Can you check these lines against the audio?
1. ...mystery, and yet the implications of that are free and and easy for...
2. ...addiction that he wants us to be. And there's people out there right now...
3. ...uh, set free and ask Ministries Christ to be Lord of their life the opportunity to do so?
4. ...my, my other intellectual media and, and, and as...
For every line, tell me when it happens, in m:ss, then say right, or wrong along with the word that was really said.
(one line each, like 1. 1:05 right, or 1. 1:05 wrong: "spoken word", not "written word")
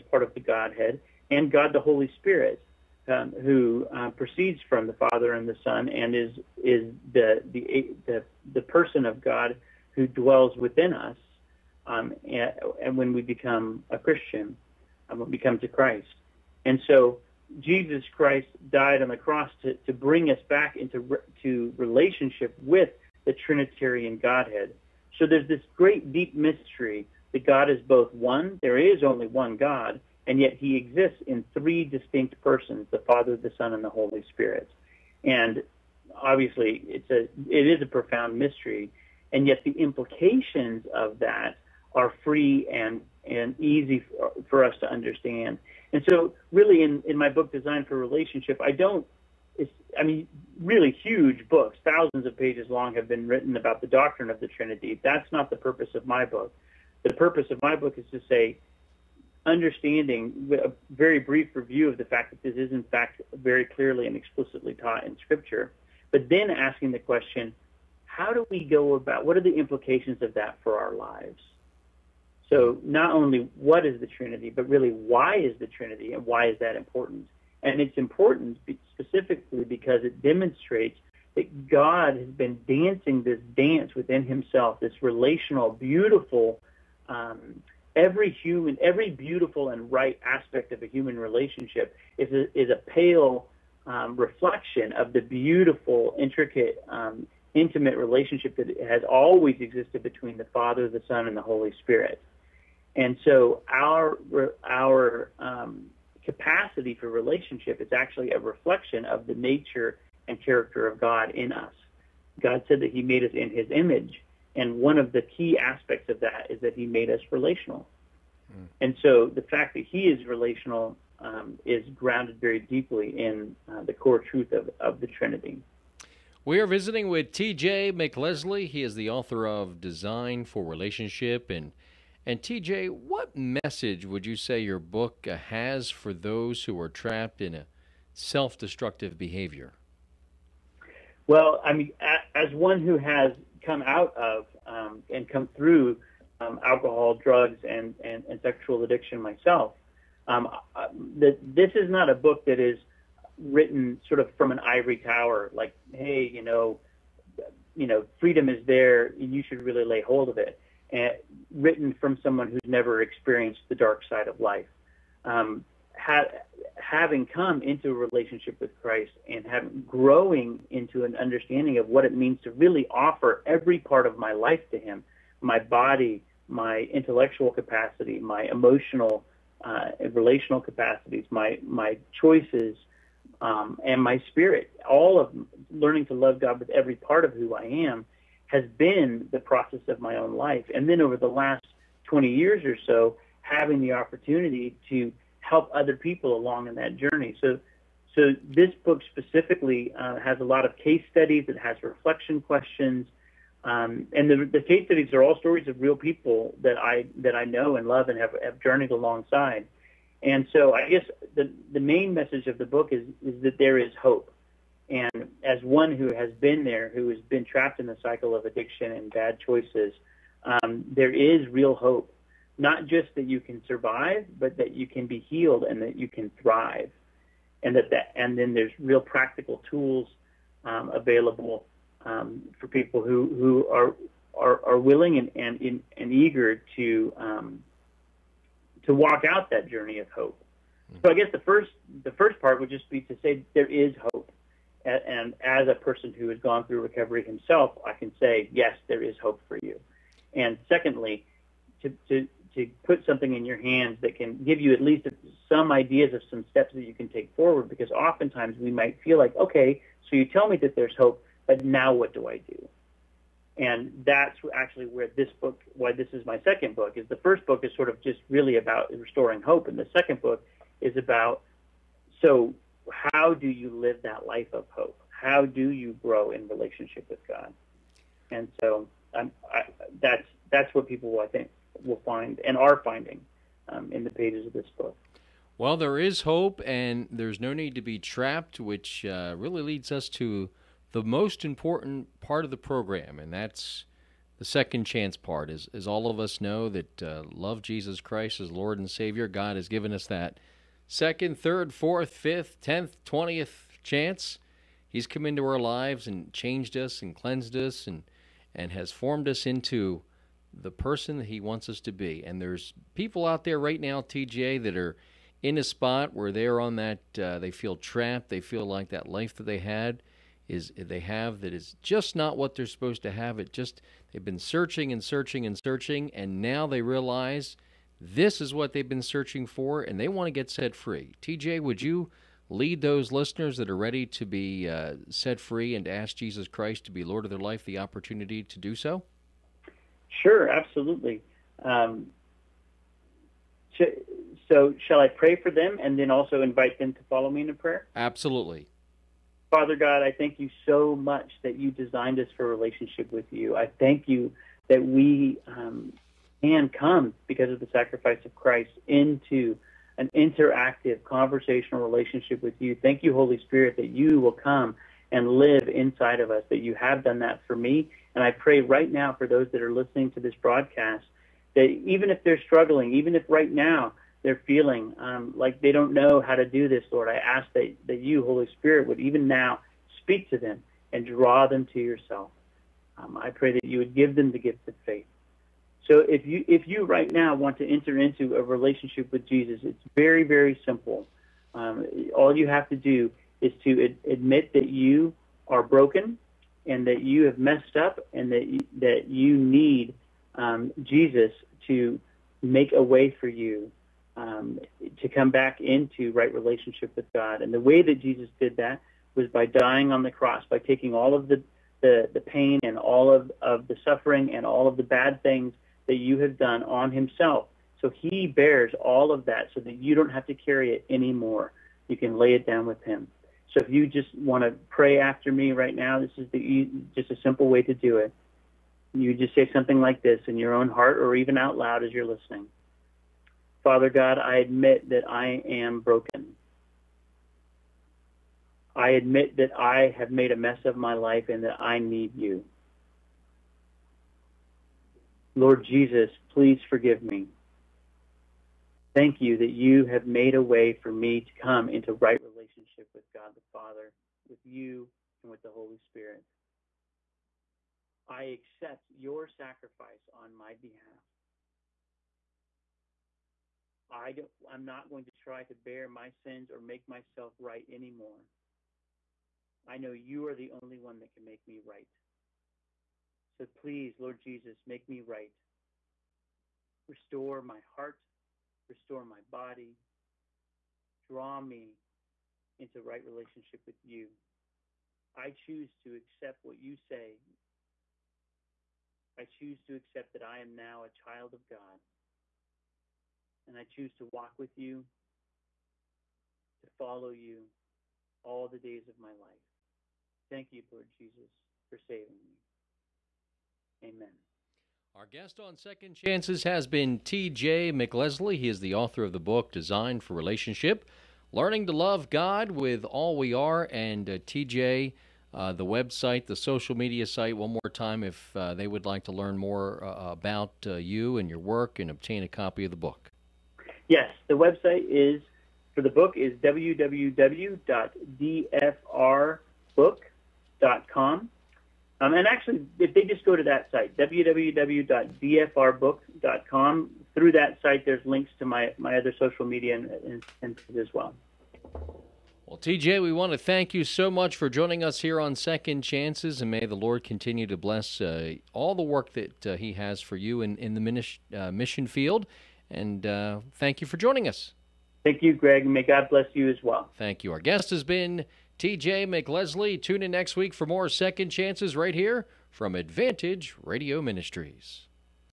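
1. 0:38 right
2. 5:10 wrong: "person", not "addiction"
3. 5:34 wrong: "Jesus", not "Ministries"
4. 8:58 wrong: "social", not "intellectual".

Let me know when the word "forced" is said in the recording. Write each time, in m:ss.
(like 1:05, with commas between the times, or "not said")
not said.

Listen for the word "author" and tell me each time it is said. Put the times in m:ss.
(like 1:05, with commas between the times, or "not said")
2:09, 8:28.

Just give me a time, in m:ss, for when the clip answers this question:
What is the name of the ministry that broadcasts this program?
9:22.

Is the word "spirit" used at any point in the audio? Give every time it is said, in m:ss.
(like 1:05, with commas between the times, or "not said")
0:02, 0:34, 1:41, 3:04, 6:03, 6:18, 7:35.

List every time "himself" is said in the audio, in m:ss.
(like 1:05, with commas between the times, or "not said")
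1:24, 4:07, 6:56.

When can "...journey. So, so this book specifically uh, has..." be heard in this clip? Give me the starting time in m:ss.
3:16.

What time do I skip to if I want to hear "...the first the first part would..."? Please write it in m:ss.
4:01.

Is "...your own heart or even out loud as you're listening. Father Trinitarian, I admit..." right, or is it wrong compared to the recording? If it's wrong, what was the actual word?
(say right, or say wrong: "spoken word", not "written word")
wrong: "God", not "Trinitarian".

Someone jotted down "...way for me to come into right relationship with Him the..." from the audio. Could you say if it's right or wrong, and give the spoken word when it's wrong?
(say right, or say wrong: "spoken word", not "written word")
wrong: "God", not "Him".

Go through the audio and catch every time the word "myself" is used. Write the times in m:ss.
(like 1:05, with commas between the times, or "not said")
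2:29, 7:46.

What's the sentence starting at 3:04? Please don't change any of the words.
All of learning to love God with every part of who I am has been the process of my own life.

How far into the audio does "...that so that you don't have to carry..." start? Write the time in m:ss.
6:59.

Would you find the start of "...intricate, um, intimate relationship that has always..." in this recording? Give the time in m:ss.
1:36.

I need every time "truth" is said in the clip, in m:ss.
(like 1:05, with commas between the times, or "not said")
2:04.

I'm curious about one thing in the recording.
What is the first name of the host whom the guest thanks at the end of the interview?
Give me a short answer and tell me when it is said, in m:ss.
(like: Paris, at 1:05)
Greg, at 9:15.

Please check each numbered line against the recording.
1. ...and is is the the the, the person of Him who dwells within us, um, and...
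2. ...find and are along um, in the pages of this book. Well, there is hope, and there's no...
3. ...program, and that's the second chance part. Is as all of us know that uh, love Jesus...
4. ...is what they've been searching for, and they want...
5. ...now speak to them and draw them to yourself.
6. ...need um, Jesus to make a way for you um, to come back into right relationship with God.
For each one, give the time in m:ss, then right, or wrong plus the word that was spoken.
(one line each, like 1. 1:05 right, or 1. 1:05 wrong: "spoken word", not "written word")
1. 0:05 wrong: "God", not "Him"
2. 4:42 wrong: "finding", not "along"
3. 4:52 right
4. 5:28 right
5. 6:19 right
6. 6:39 right.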